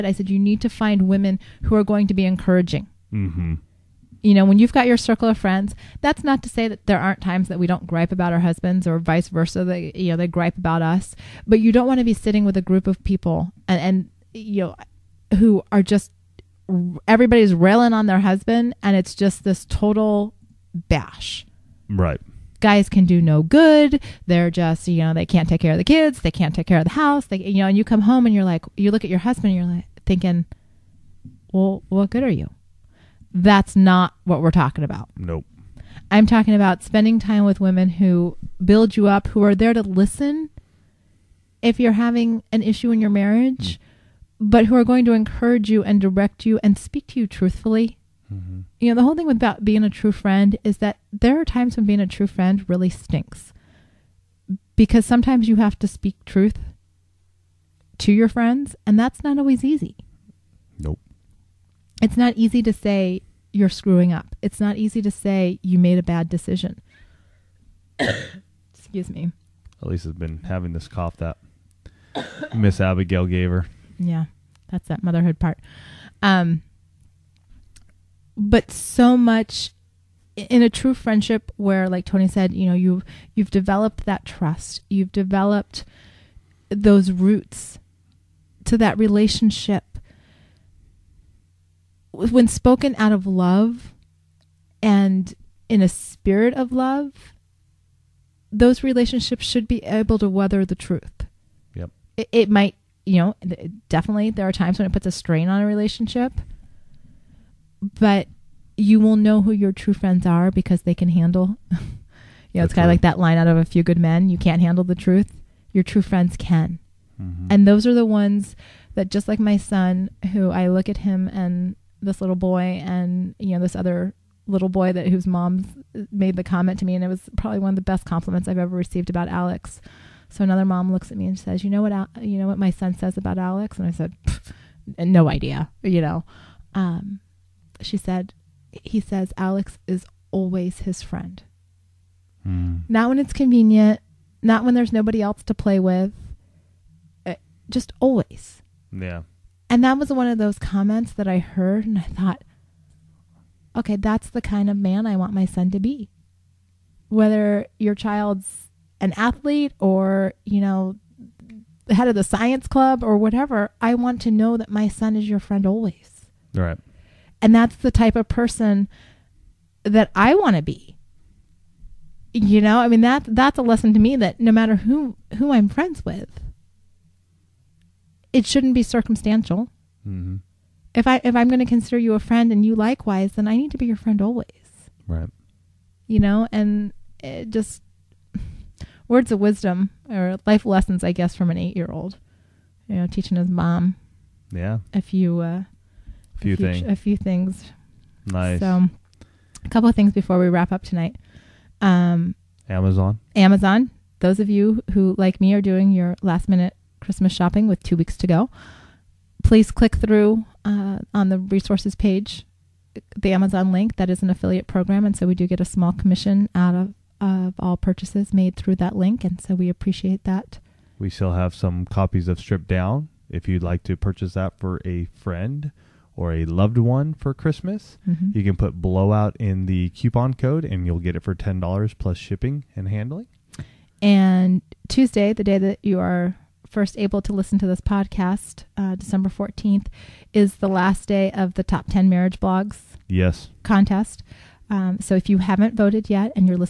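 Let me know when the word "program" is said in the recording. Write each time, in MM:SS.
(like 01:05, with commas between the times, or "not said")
03:34.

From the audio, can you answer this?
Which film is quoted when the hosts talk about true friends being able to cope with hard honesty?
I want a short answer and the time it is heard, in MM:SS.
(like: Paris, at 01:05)
A Few Good Men, at 01:53.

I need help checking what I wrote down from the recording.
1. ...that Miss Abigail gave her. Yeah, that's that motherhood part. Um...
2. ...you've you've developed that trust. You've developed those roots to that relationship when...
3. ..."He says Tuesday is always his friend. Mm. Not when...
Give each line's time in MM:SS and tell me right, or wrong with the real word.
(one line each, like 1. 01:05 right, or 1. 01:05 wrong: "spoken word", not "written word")
1. 01:11 right
2. 01:22 right
3. 02:18 wrong: "Alex", not "Tuesday".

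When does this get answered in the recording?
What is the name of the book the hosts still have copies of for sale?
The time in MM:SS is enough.
03:42.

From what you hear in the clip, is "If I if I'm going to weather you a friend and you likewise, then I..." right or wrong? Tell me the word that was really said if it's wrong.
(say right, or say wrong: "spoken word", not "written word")
wrong: "consider", not "weather".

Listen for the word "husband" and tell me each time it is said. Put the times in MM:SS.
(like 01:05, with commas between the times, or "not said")
00:08, 00:18, 00:29.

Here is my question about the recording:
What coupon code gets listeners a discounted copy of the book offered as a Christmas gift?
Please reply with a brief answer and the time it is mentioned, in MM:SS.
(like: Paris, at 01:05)
blowout, at 03:48.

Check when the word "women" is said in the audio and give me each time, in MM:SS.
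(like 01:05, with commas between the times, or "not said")
00:01, 00:37.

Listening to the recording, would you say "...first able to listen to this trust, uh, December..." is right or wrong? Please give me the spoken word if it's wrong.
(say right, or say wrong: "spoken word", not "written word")
wrong: "podcast", not "trust".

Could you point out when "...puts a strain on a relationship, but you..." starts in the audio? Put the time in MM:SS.
01:44.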